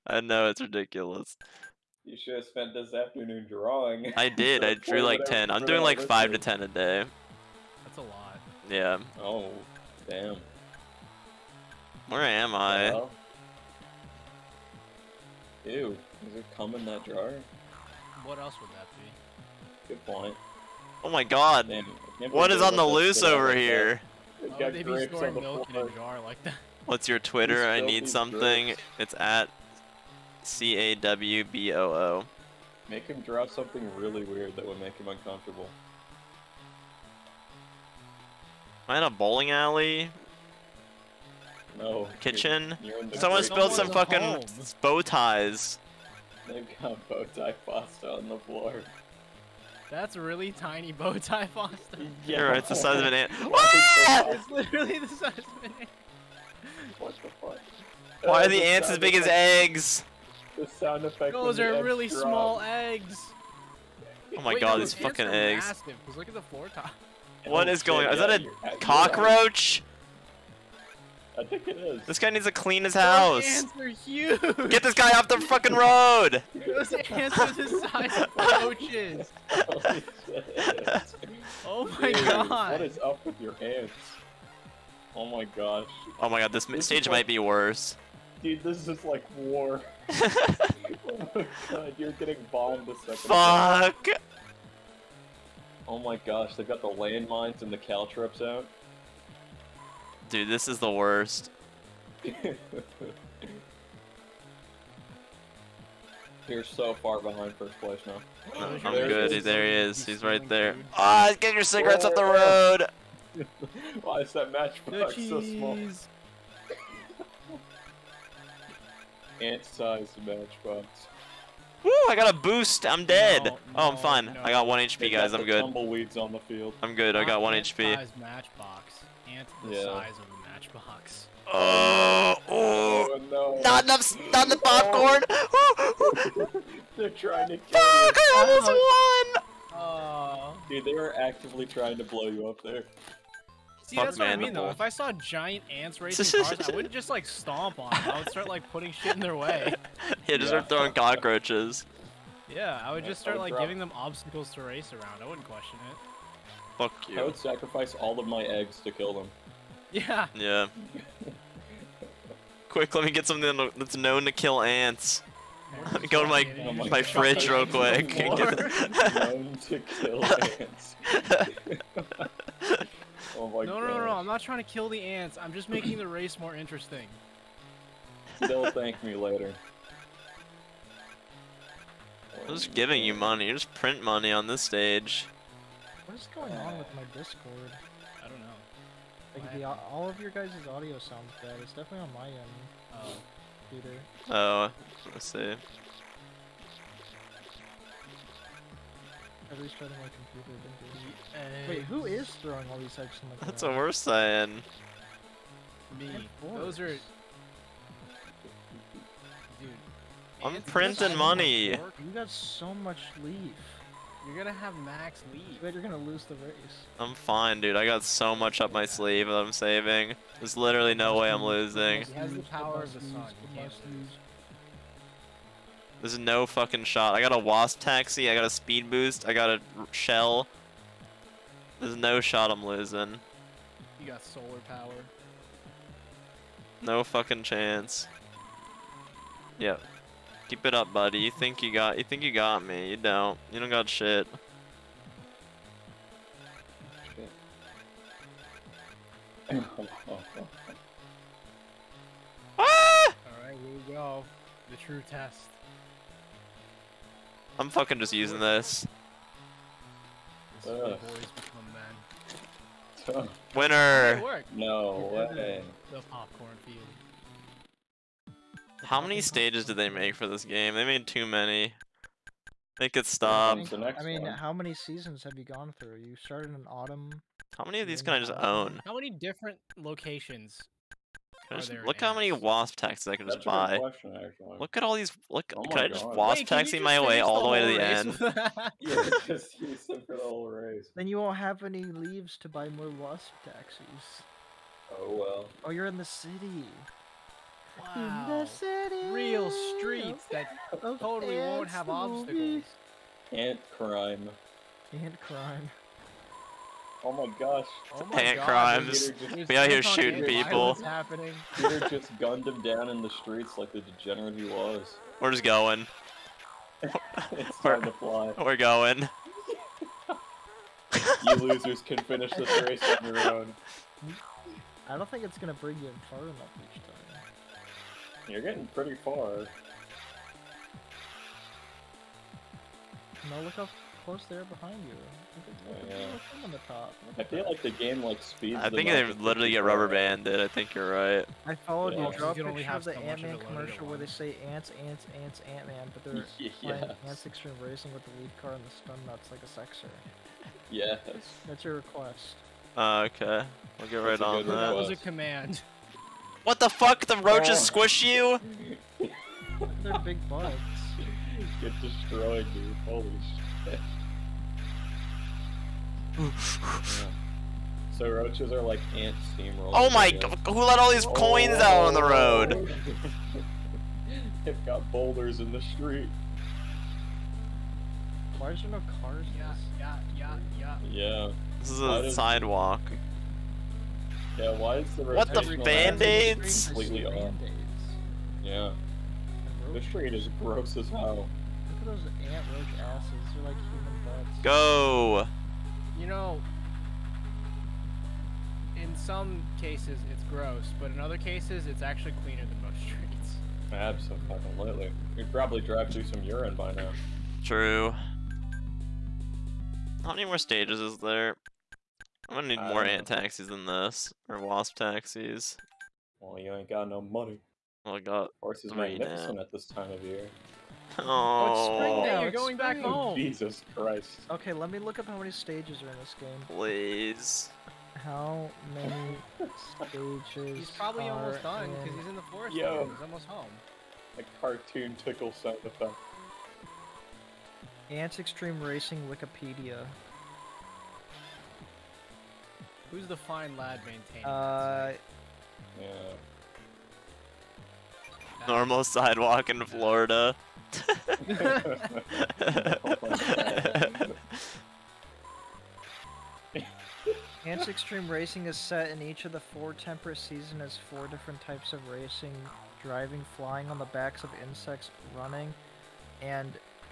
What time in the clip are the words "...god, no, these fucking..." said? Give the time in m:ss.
1:04.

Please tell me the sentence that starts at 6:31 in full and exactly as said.
Look at those ant roach asses.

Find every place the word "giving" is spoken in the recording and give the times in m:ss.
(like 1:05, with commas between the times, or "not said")
2:33, 3:02.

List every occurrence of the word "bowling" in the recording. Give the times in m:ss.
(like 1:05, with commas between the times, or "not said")
0:39.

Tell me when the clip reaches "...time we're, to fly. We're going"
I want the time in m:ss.
5:17.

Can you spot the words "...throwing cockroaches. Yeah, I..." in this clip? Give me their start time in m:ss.
2:30.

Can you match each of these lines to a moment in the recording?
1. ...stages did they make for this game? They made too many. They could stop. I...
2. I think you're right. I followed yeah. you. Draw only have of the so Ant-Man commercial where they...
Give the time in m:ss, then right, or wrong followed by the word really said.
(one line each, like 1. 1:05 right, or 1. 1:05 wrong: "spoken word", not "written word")
1. 4:29 right
2. 5:40 right.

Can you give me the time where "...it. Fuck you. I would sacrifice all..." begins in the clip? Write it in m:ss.
2:35.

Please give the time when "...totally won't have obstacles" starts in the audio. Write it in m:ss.
5:00.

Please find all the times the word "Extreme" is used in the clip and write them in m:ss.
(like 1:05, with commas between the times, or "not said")
5:47, 7:18, 7:37.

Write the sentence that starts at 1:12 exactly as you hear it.
This guy needs to clean his house.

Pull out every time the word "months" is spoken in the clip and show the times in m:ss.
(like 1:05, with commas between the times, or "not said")
not said.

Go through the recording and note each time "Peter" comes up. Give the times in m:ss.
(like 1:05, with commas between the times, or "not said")
3:13, 5:11.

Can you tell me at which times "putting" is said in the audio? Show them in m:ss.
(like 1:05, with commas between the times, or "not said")
2:28.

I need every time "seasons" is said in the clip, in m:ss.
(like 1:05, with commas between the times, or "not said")
4:34, 7:40.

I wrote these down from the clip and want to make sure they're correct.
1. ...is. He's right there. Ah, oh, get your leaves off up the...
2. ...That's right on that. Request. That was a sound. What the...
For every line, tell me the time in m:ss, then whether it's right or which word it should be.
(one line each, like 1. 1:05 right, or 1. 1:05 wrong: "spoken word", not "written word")
1. 1:49 wrong: "cigarettes", not "leaves"
2. 5:54 wrong: "command", not "sound".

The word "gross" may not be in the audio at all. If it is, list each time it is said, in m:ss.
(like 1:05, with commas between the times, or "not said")
6:30, 6:40.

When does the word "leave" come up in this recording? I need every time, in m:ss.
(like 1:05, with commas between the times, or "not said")
3:35, 4:51.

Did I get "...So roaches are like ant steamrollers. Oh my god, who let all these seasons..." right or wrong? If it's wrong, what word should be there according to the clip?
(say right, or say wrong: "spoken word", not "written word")
wrong: "coins", not "seasons".